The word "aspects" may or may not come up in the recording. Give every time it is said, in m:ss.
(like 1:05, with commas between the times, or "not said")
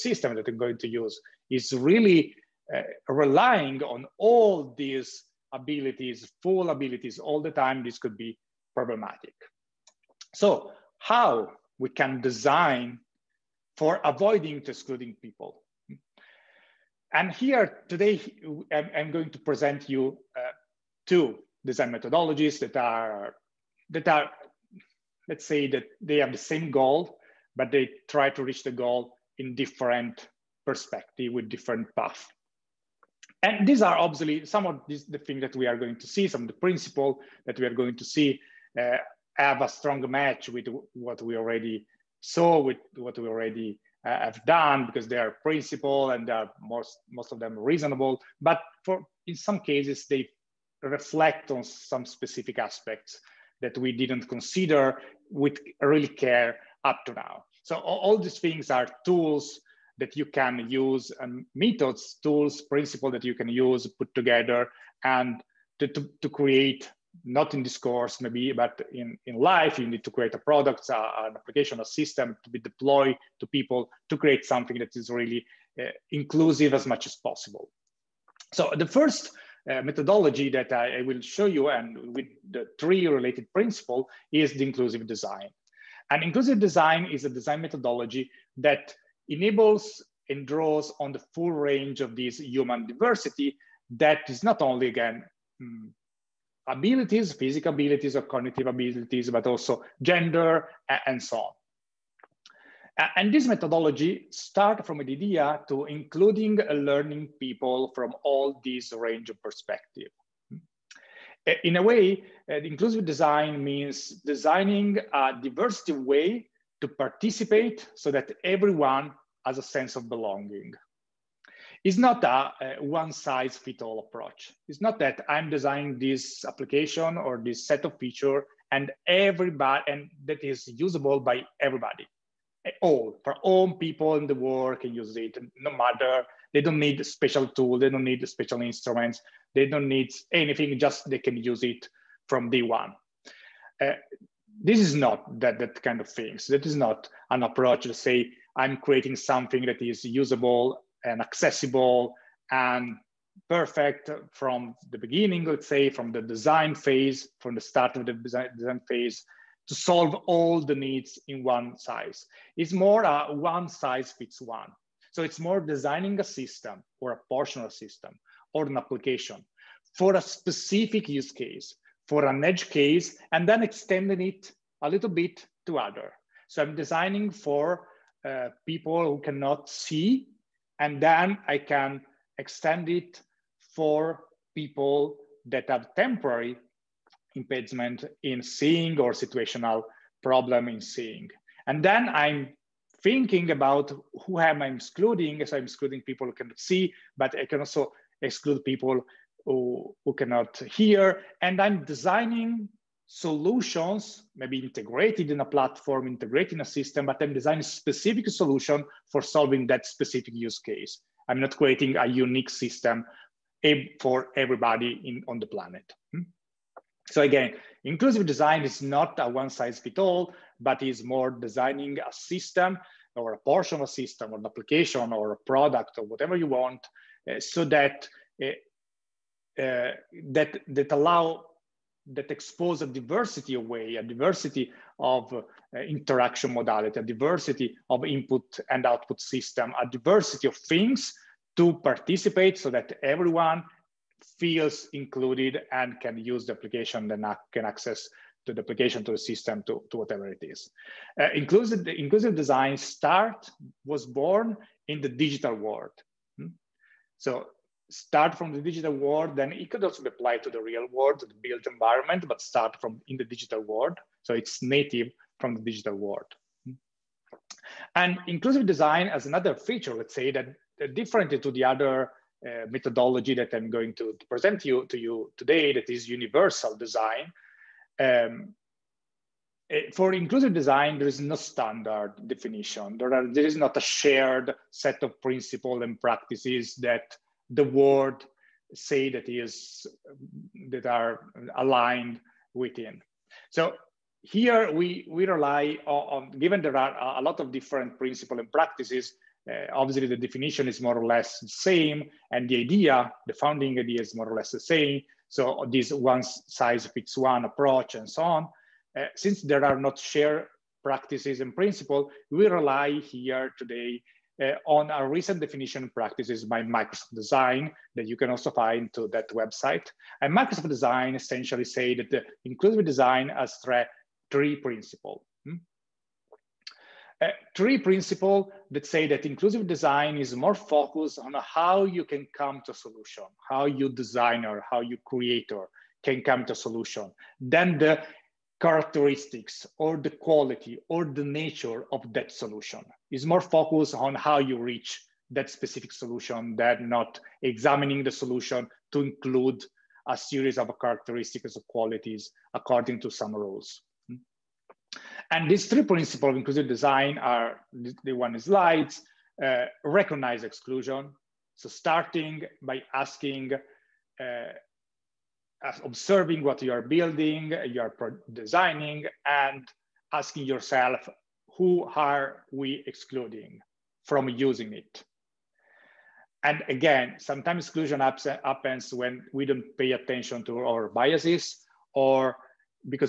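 0:52.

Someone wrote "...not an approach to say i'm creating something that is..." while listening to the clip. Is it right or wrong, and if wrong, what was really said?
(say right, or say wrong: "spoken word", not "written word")
right.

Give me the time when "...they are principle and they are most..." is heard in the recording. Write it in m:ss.
0:45.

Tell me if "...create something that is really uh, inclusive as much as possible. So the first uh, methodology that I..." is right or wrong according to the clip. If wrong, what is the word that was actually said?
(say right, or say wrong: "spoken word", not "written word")
right.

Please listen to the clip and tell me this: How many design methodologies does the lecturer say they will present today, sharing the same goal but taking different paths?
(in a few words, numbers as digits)
2.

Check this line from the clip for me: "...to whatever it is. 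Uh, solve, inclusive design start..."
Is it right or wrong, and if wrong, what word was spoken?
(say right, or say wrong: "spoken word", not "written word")
wrong: "inclusive", not "solve".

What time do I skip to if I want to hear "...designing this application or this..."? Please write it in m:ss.
2:05.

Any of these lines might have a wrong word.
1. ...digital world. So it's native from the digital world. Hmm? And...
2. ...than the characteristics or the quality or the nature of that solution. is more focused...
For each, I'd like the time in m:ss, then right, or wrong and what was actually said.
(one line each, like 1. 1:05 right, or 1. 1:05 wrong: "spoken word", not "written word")
1. 4:23 right
2. 5:37 right.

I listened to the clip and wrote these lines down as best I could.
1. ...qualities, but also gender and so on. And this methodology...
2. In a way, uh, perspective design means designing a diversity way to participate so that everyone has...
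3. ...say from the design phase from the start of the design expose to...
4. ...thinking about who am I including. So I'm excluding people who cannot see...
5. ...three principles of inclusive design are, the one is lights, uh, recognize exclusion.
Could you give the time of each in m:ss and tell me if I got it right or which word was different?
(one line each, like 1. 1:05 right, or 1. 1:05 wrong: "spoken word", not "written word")
1. 1:38 wrong: "abilities", not "qualities"
2. 1:51 wrong: "inclusive", not "perspective"
3. 2:35 wrong: "phase", not "expose"
4. 3:13 wrong: "excluding", not "including"
5. 5:55 right.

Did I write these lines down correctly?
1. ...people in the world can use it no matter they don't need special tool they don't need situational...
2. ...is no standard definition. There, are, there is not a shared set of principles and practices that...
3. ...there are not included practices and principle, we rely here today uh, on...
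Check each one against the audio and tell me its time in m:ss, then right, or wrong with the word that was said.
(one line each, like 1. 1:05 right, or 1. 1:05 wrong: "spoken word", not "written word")
1. 2:13 wrong: "special", not "situational"
2. 4:41 right
3. 5:09 wrong: "shared", not "included".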